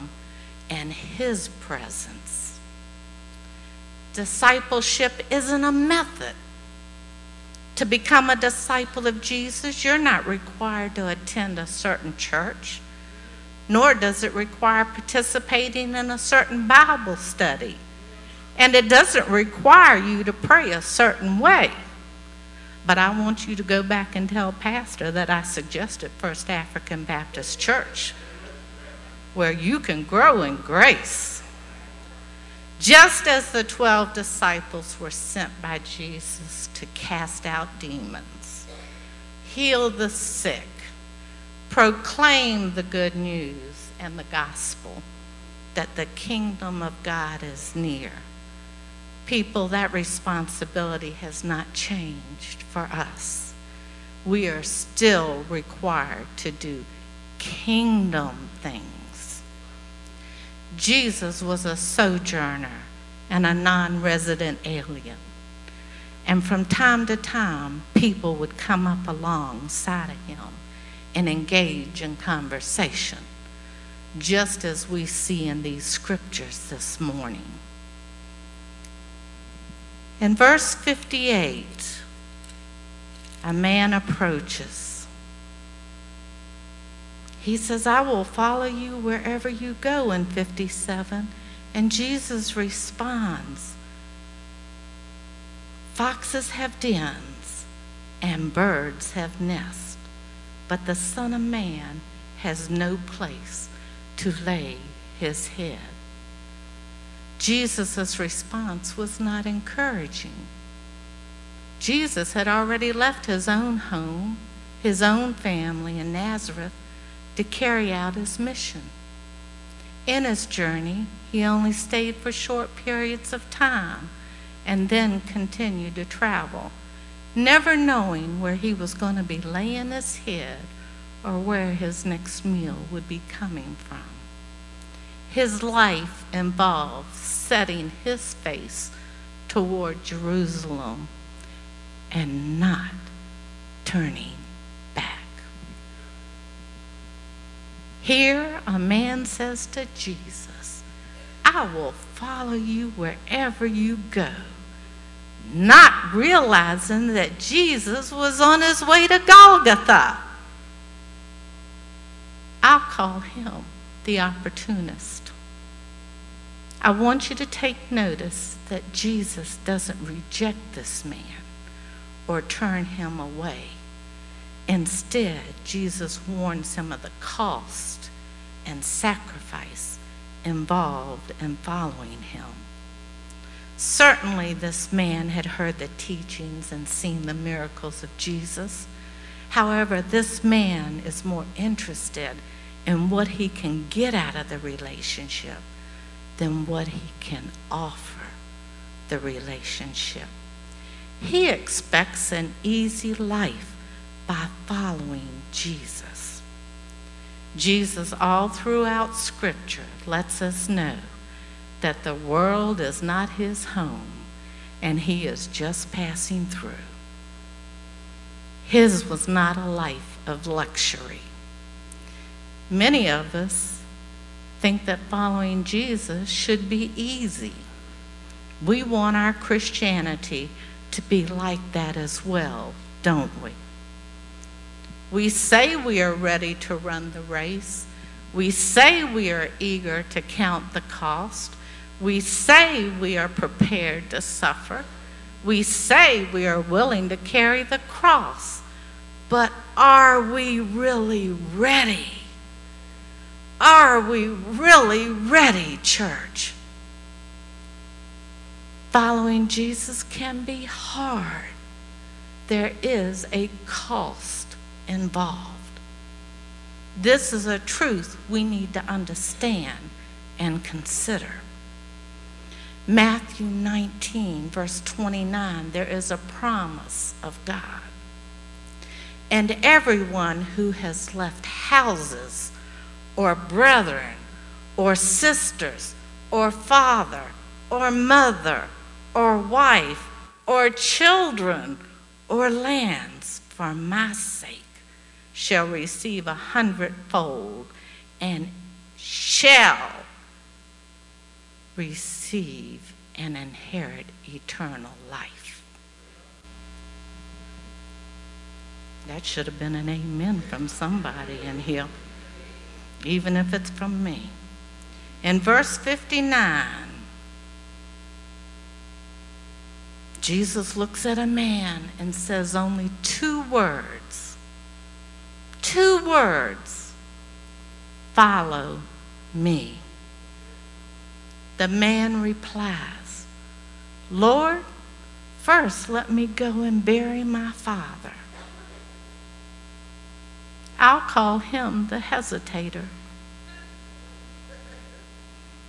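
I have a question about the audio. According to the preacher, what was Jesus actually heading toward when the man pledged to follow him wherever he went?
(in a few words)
Golgotha.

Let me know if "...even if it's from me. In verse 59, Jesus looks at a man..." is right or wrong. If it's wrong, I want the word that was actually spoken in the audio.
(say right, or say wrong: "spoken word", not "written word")
right.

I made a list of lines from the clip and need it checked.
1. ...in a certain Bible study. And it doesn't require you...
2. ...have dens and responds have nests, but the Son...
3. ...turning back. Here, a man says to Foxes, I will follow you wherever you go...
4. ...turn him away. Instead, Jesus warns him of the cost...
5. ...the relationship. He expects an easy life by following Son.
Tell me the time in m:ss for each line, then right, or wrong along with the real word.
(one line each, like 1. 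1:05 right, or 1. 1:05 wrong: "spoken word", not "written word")
1. 0:15 right
2. 1:36 wrong: "birds", not "responds"
3. 2:23 wrong: "Jesus", not "Foxes"
4. 2:52 right
5. 3:19 wrong: "Jesus", not "Son".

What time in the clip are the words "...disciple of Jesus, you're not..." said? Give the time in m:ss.
0:08.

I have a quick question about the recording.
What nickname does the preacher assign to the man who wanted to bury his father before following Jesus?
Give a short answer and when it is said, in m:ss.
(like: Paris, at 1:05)
The hesitator, at 5:41.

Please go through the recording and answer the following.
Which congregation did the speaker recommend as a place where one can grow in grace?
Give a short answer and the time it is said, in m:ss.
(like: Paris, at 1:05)
First African Baptist Church, at 0:26.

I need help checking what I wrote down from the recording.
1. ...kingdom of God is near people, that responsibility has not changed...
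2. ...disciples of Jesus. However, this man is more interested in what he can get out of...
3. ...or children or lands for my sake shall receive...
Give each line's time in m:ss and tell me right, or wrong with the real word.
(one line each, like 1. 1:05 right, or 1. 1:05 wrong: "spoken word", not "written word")
1. 0:46 right
2. 3:07 wrong: "miracles", not "disciples"
3. 4:50 right.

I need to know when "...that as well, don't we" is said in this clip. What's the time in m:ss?
3:51.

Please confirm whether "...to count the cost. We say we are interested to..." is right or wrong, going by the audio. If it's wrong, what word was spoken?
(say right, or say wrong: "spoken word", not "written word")
wrong: "prepared", not "interested".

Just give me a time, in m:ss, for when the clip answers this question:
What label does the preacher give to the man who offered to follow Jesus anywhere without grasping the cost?
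2:44.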